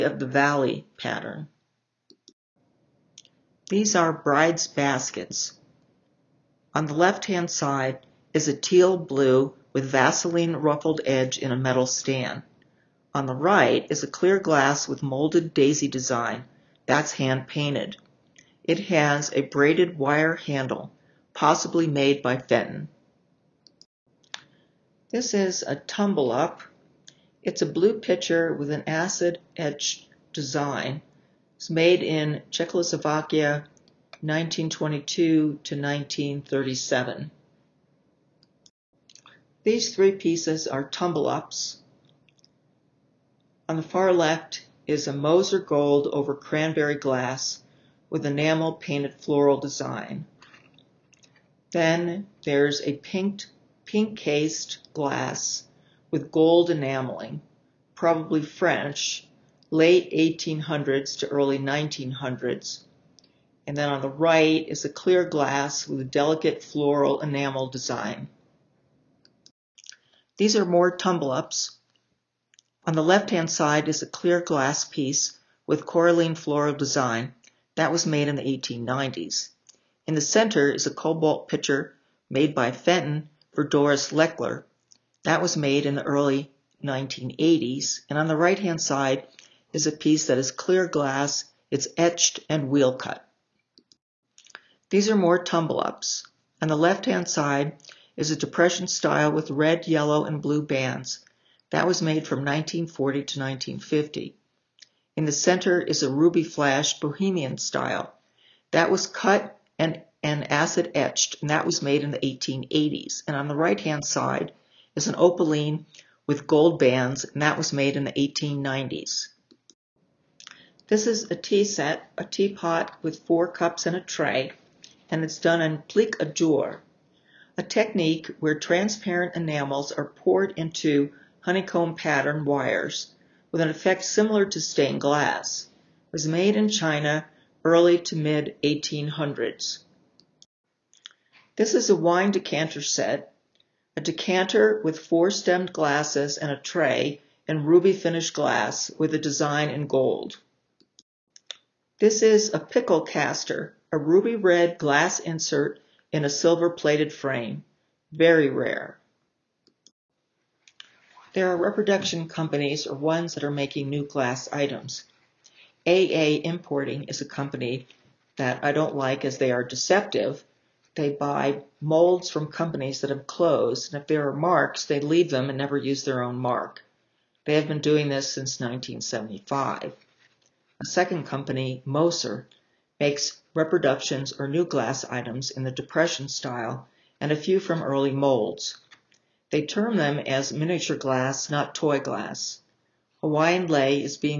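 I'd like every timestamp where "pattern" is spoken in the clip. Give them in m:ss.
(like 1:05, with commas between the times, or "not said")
0:00, 2:11.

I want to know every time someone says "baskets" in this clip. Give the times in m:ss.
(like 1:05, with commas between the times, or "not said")
0:04.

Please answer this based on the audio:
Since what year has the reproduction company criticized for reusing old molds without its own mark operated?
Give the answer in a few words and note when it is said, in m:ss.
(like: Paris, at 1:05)
1975, at 2:58.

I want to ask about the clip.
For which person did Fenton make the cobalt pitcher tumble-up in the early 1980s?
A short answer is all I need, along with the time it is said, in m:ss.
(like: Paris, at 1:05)
Doris Lechler, at 1:23.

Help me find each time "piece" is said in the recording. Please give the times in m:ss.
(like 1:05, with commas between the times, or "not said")
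0:40, 1:14, 1:29.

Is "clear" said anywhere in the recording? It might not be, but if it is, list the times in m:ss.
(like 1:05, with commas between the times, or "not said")
0:14, 1:04, 1:14, 1:30.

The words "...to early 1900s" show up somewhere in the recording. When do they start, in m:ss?
1:01.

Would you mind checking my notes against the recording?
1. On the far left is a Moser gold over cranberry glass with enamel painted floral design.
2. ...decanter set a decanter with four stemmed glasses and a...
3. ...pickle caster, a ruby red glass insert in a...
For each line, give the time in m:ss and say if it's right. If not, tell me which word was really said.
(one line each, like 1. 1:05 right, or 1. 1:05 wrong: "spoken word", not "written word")
1. 0:43 right
2. 2:22 right
3. 2:32 right.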